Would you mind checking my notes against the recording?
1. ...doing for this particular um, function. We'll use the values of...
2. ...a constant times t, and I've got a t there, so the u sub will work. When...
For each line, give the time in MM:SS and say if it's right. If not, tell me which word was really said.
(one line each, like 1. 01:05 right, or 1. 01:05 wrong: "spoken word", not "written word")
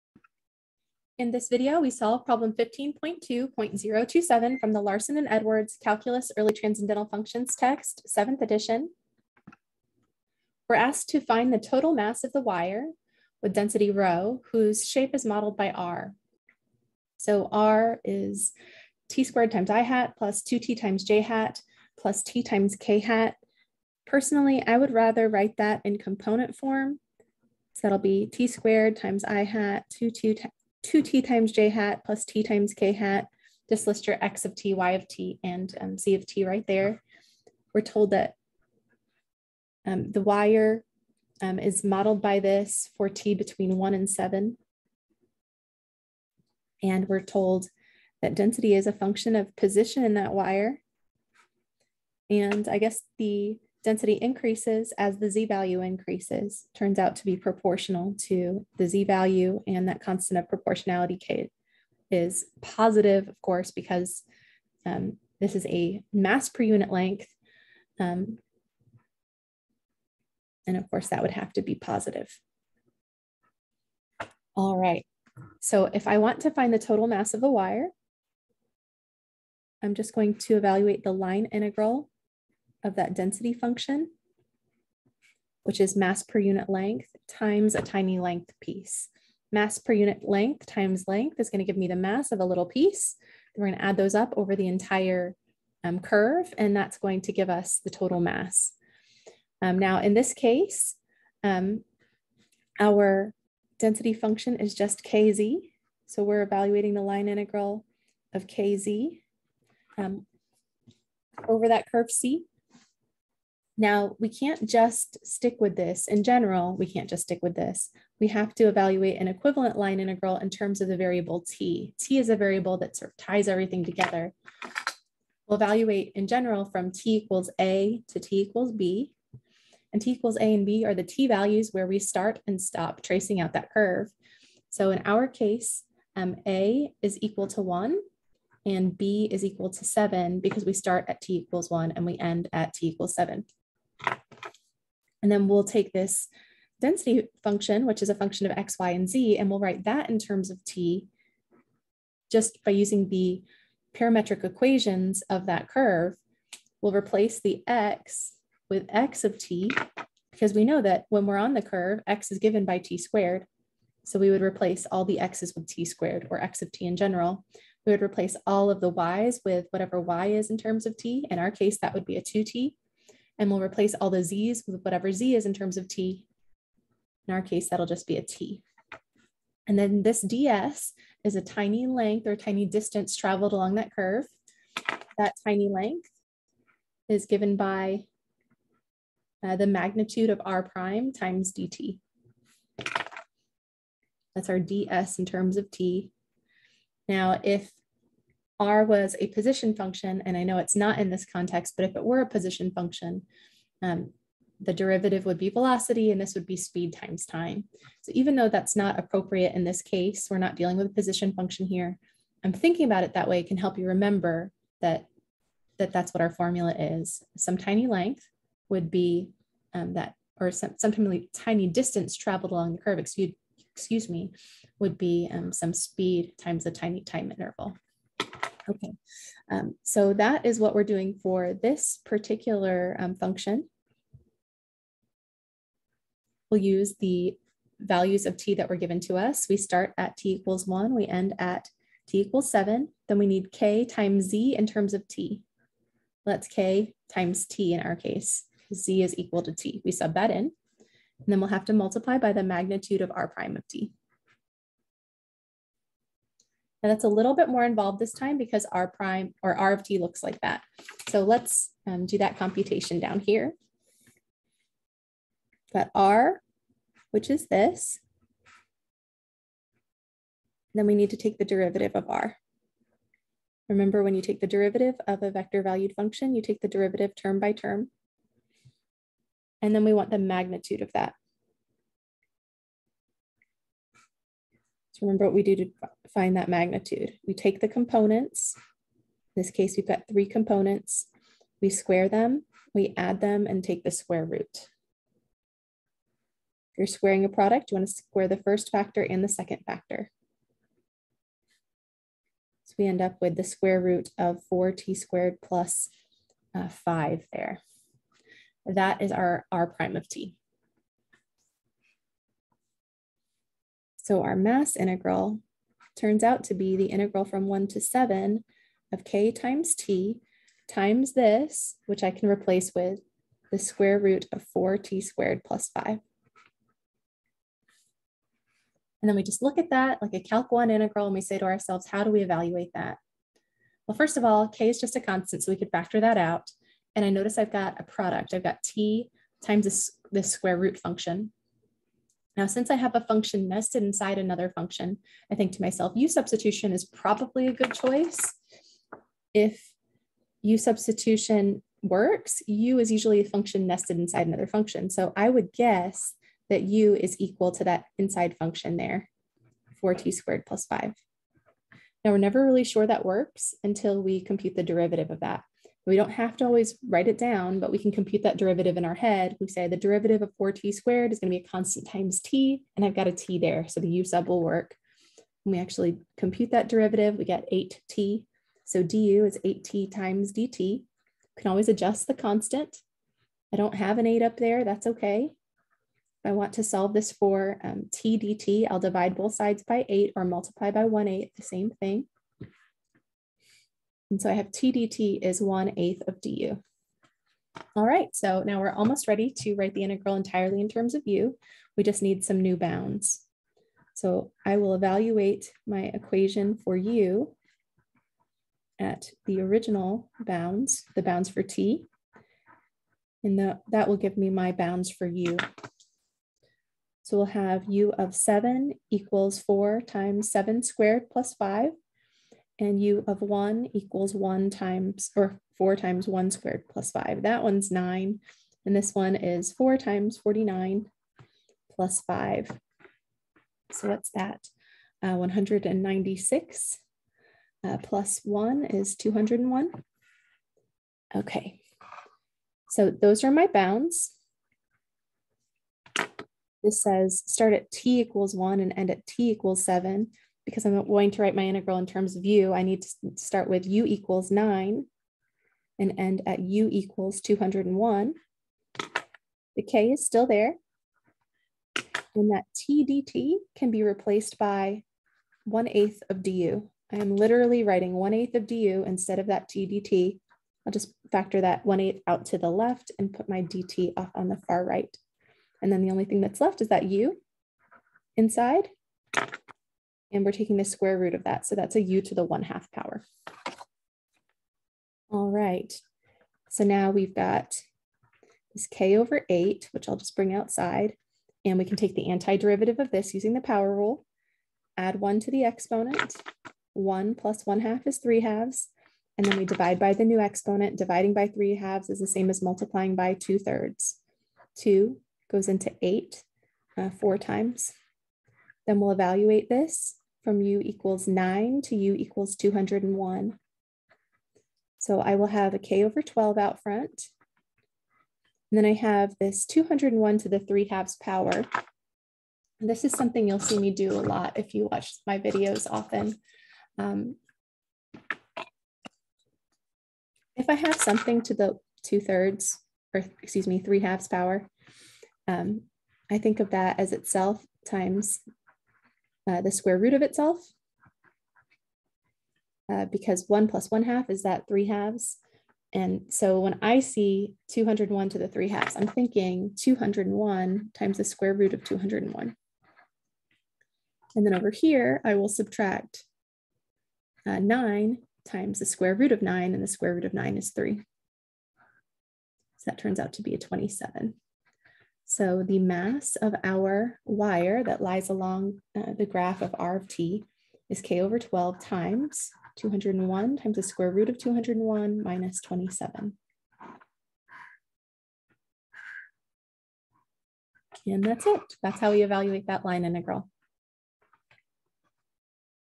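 1. 03:50 right
2. 06:11 right.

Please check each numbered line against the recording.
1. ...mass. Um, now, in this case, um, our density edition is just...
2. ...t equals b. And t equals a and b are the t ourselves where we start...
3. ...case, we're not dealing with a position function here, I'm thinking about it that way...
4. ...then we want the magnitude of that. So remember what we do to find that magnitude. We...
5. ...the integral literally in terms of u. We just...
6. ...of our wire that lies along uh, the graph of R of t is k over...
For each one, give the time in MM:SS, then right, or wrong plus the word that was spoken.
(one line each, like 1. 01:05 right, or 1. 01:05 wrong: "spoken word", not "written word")
1. 01:38 wrong: "function", not "edition"
2. 02:08 wrong: "values", not "ourselves"
3. 03:29 right
4. 04:39 right
5. 06:39 wrong: "entirely", not "literally"
6. 09:26 right.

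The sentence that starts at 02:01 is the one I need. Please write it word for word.
t is a variable that sort of ties everything together.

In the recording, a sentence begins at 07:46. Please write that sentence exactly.
I am literally writing 1 eighth of du instead of that t dt.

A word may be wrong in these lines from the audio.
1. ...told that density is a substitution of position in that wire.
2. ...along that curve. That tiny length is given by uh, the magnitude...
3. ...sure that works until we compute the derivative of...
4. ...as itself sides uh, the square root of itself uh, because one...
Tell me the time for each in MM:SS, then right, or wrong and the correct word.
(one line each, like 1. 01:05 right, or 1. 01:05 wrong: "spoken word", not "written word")
1. 00:47 wrong: "function", not "substitution"
2. 03:03 right
3. 06:02 right
4. 08:56 wrong: "times", not "sides".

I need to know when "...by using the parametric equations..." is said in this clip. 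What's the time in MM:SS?
02:32.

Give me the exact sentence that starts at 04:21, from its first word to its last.
So let's um, do that computation down here.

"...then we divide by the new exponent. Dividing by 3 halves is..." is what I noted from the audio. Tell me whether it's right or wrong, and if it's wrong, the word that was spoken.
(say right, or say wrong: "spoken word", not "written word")
right.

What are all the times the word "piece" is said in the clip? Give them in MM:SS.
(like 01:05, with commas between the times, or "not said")
01:28, 01:32.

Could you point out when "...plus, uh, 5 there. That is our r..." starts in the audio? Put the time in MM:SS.
05:05.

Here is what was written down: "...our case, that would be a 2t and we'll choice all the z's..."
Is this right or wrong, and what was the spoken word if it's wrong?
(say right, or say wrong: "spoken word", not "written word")
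wrong: "replace", not "choice".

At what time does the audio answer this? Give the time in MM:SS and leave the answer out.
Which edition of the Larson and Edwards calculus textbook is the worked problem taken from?
00:08.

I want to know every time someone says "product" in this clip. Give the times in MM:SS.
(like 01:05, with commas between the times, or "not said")
04:57, 05:37.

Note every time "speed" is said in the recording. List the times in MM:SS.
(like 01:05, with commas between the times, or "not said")
03:26, 03:45.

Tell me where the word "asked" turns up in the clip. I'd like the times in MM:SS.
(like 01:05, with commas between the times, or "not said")
00:10.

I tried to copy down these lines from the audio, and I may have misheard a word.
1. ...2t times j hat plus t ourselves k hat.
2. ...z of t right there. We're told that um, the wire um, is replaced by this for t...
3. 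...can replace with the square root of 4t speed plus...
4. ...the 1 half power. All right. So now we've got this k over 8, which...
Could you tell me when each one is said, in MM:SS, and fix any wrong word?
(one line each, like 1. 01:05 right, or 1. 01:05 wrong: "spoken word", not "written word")
1. 00:20 wrong: "times", not "ourselves"
2. 00:35 wrong: "modeled", not "replaced"
3. 05:22 wrong: "squared", not "speed"
4. 08:02 right.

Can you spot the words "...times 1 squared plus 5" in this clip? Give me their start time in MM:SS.
07:05.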